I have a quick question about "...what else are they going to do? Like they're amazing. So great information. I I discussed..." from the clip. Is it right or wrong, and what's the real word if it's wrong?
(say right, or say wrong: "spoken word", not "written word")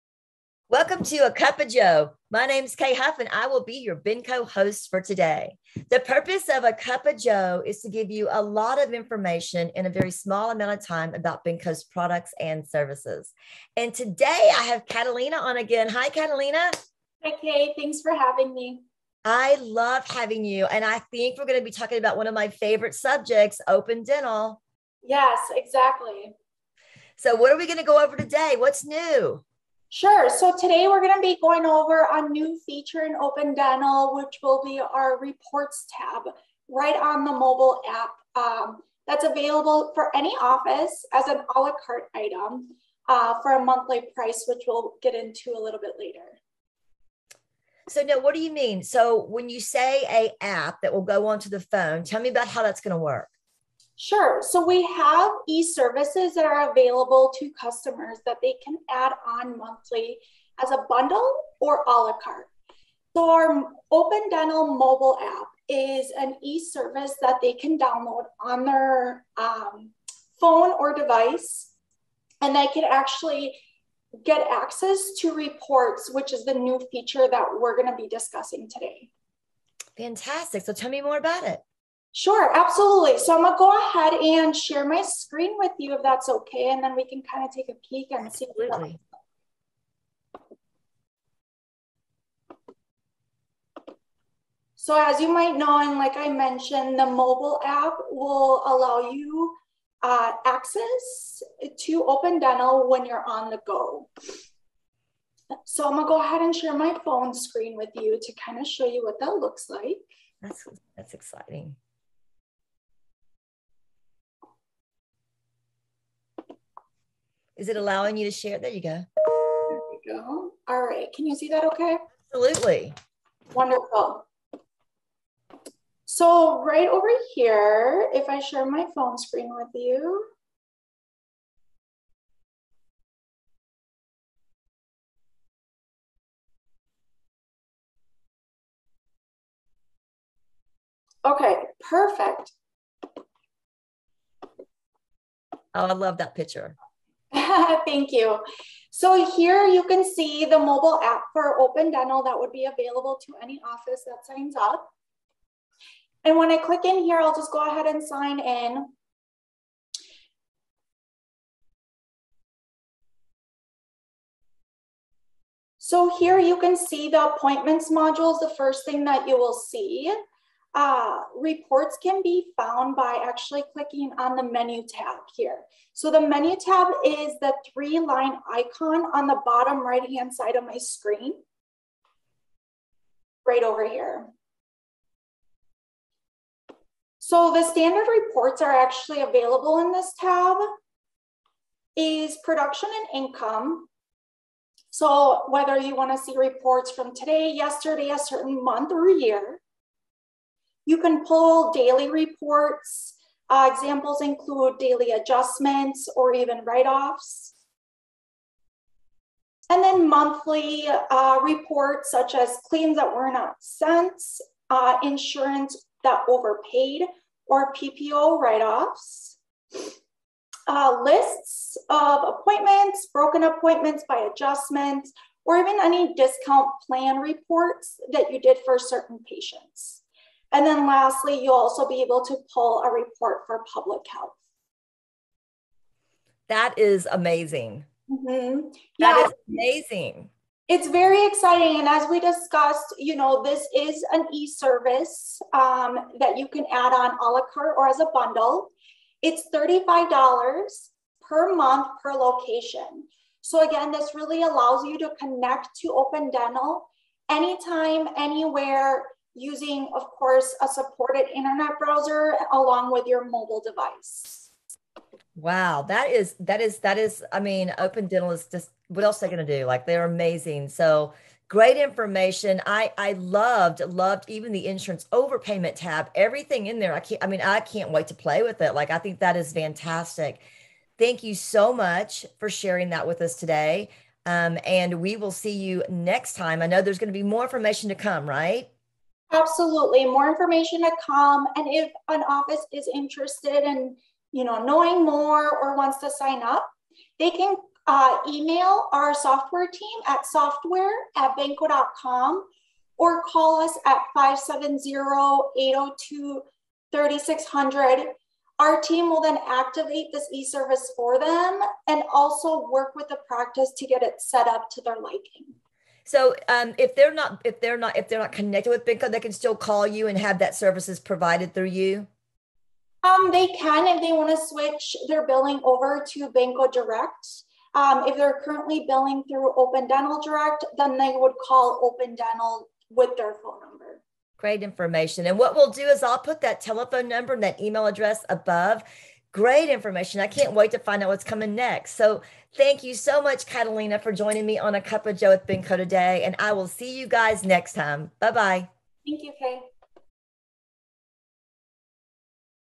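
wrong: "loved", not "discussed".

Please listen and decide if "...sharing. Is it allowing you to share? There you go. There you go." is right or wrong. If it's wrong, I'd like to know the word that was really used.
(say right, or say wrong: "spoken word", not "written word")
wrong: "exciting", not "sharing".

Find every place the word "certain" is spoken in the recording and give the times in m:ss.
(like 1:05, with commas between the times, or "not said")
3:18, 3:48.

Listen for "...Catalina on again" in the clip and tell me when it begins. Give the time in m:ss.
0:14.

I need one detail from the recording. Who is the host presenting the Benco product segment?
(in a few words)
Kay Huff.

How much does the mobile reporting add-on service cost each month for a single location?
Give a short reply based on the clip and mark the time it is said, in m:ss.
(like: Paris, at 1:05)
$35, at 4:09.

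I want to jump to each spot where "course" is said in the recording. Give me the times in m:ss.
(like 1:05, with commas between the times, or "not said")
4:20.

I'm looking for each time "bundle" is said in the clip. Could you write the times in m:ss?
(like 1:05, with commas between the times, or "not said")
1:00, 4:08.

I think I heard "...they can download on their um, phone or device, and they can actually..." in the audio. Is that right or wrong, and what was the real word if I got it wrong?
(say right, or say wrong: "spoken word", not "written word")
right.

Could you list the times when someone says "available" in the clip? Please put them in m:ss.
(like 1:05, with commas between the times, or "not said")
0:39, 0:56, 2:32, 3:09.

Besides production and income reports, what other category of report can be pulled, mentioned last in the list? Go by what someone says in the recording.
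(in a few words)
public health.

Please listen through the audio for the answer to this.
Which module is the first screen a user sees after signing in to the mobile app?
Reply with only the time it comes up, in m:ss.
2:47.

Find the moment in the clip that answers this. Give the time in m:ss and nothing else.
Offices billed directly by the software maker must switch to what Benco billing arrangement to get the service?
5:26.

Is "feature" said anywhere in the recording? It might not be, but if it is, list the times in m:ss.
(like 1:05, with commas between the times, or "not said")
0:32, 1:16.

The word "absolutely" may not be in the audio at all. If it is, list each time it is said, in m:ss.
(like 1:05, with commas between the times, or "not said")
1:22, 1:28, 2:02, 4:49.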